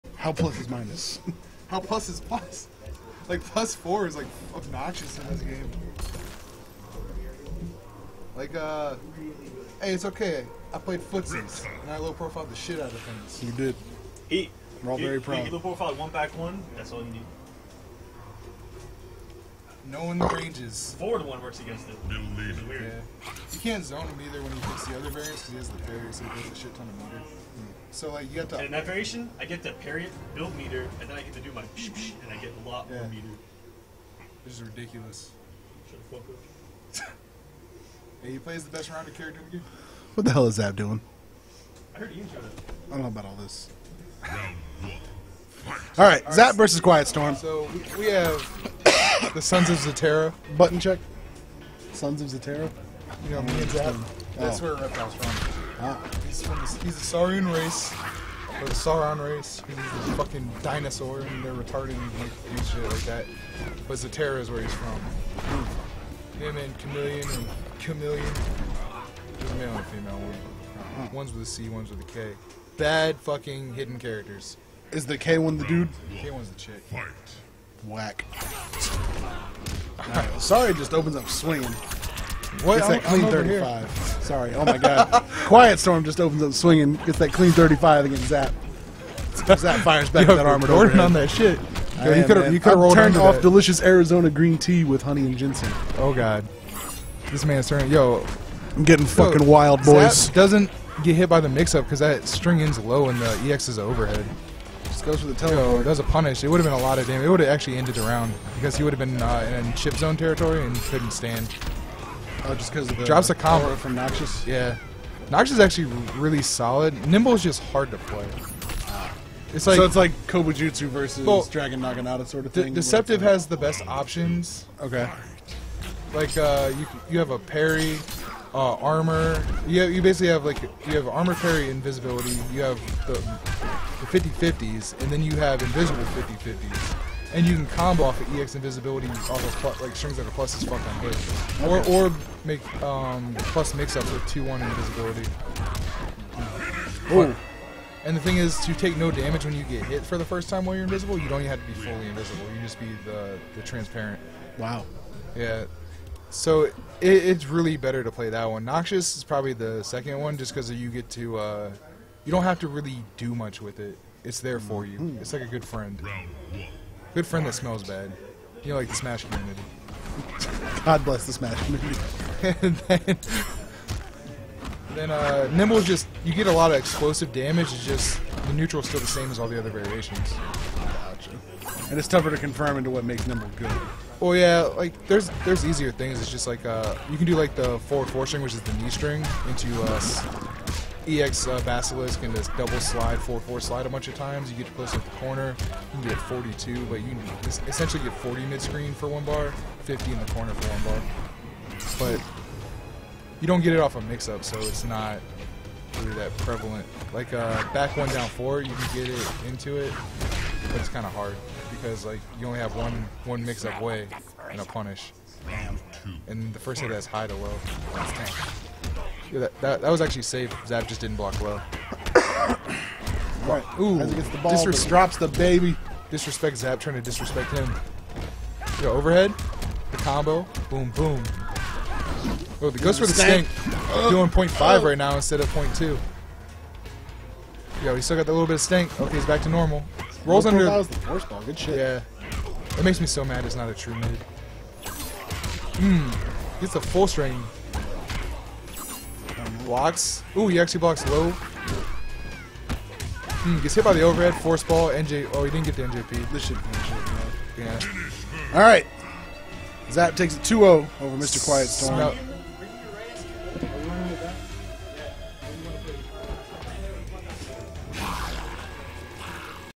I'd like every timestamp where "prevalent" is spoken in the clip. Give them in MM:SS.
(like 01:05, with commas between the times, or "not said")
03:26.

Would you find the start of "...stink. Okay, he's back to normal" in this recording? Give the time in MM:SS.
03:58.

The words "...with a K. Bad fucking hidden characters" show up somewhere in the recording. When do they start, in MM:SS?
01:11.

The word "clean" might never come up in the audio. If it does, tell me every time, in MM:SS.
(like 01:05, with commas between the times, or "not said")
01:23, 01:27.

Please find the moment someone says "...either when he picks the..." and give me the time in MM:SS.
00:24.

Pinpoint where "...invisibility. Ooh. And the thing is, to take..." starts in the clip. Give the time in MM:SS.
02:24.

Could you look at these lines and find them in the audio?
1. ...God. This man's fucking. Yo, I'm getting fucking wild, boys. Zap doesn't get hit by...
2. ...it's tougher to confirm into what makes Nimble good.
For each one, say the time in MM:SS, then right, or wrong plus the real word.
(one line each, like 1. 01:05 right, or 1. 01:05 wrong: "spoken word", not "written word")
1. 01:36 wrong: "turning", not "fucking"
2. 03:01 right.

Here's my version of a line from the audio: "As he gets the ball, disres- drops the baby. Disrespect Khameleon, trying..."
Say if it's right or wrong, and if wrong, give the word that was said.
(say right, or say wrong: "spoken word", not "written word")
wrong: "Zap", not "Khameleon".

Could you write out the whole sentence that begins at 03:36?
And the first hit that's high to low.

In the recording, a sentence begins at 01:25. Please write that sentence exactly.
Quiet Storm just opens up swinging.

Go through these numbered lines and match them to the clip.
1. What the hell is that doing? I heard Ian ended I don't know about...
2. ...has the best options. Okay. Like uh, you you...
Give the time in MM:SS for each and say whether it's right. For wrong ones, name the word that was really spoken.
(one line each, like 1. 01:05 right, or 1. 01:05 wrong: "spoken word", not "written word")
1. 00:40 wrong: "showed", not "ended"
2. 02:03 right.